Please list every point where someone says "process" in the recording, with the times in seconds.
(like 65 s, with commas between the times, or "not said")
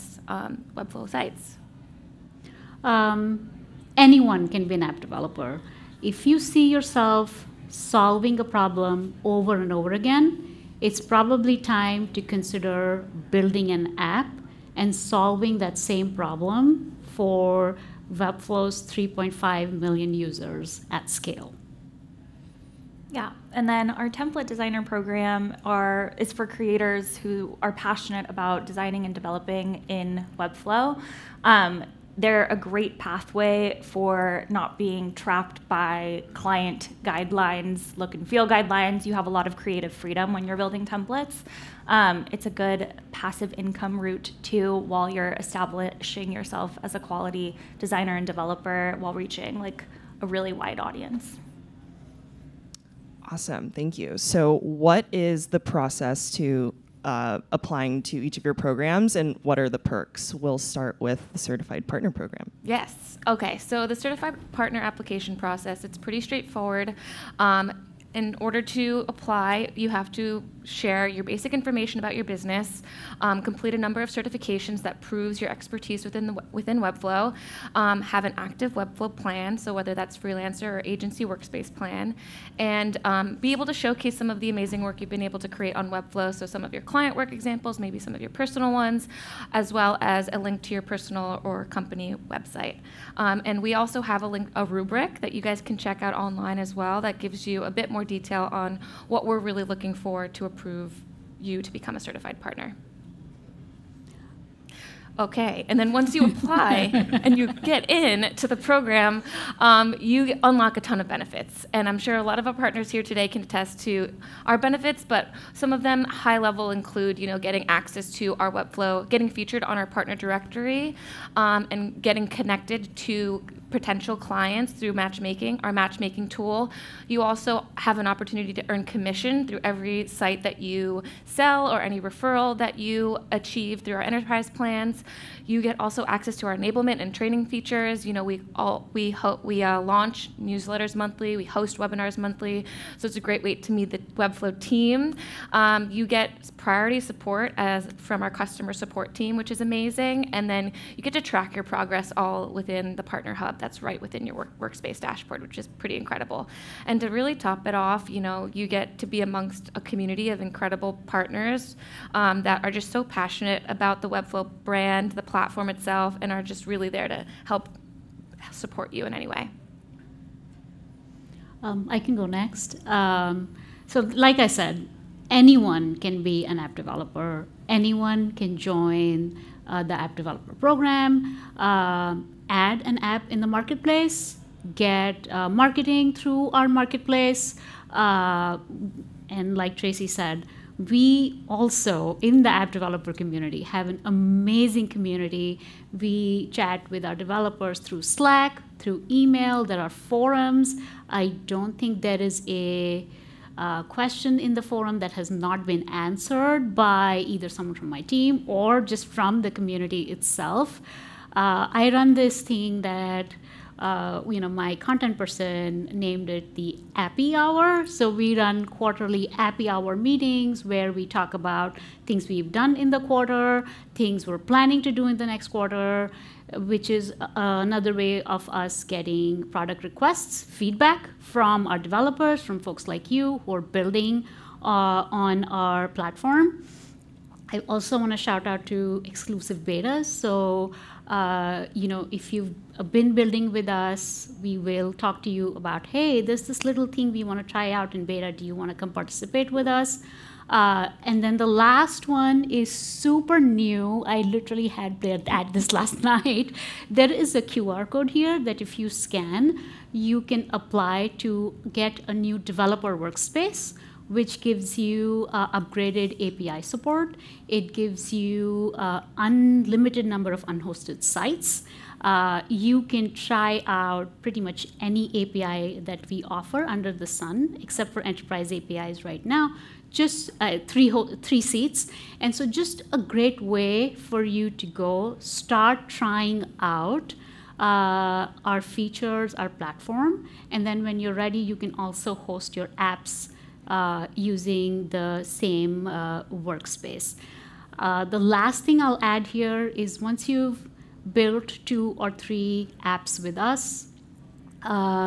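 55 s, 65 s.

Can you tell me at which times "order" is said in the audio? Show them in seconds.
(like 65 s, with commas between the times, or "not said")
68 s.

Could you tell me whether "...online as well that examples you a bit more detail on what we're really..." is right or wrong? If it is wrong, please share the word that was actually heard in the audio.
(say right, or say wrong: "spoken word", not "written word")
wrong: "gives", not "examples".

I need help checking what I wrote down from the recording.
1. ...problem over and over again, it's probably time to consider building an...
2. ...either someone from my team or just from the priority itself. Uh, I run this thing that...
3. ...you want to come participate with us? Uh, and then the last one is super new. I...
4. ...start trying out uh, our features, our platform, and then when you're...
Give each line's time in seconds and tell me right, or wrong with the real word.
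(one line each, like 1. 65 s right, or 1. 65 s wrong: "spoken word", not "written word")
1. 8 s right
2. 207 s wrong: "community", not "priority"
3. 248 s right
4. 285 s right.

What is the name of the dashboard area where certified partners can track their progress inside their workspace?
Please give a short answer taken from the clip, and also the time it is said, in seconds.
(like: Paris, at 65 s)
Partner Hub, at 153 s.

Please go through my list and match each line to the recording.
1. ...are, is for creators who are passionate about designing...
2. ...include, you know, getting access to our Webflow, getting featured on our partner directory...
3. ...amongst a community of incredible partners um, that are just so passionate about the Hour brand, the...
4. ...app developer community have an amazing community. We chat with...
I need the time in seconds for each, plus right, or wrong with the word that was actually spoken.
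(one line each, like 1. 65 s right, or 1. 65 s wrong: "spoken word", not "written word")
1. 25 s right
2. 116 s right
3. 159 s wrong: "Webflow", not "Hour"
4. 192 s right.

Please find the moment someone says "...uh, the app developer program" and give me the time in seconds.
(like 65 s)
179 s.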